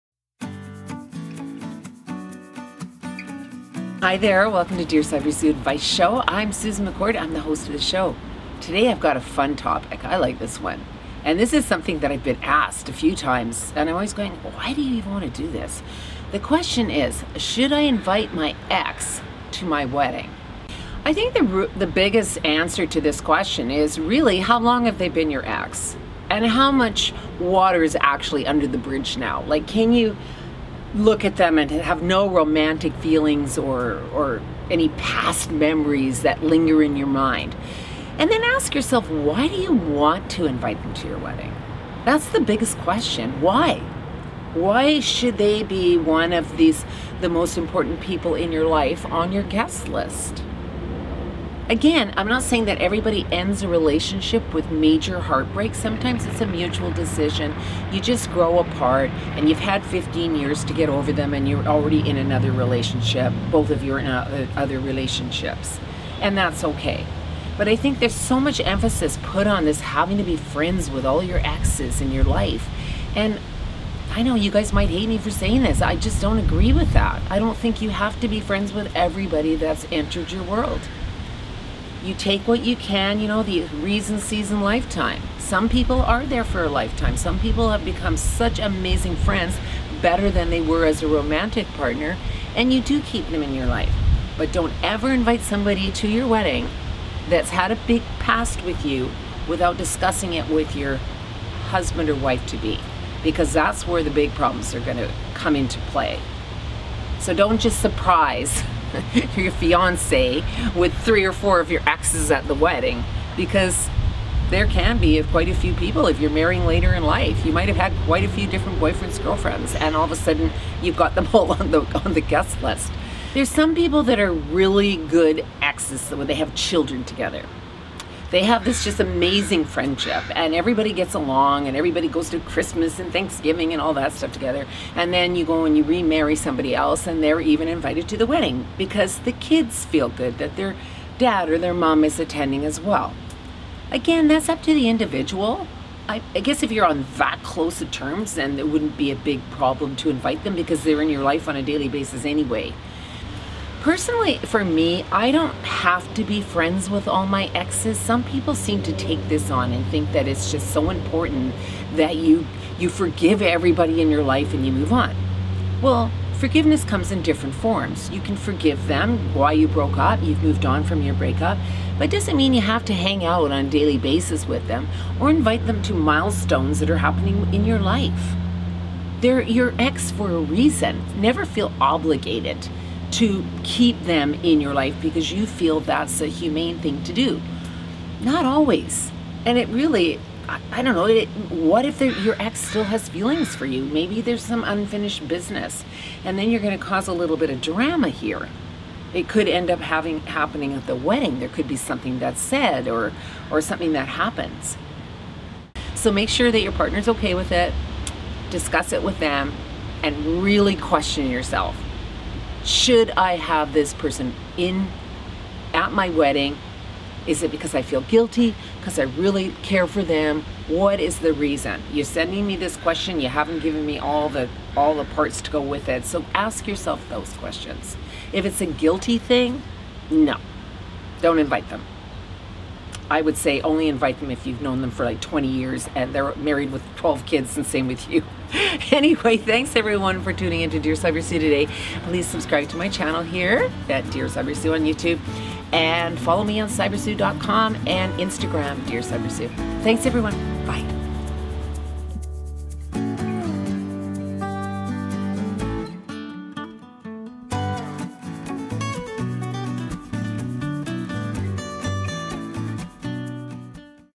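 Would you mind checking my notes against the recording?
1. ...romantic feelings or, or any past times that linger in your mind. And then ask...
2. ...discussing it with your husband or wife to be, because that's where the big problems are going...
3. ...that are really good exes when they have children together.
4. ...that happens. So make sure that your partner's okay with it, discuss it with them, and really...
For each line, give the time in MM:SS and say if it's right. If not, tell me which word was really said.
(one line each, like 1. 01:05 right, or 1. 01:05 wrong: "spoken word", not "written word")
1. 00:32 wrong: "memories", not "times"
2. 01:39 right
3. 02:04 right
4. 03:23 right.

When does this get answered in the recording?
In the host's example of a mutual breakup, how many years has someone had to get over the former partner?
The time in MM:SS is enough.
00:59.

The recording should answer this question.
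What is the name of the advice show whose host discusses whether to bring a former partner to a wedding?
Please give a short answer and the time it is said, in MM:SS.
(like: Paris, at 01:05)
Dear Sybersue Advice Show, at 00:04.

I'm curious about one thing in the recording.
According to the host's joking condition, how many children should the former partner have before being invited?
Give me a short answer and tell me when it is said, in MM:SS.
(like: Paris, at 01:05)
12, at 03:56.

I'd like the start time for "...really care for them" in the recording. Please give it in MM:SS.
03:39.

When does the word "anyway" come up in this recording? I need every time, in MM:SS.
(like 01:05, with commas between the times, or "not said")
02:32, 03:58.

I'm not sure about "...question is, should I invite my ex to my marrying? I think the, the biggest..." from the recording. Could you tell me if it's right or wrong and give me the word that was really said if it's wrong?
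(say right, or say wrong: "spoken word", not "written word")
wrong: "wedding", not "marrying".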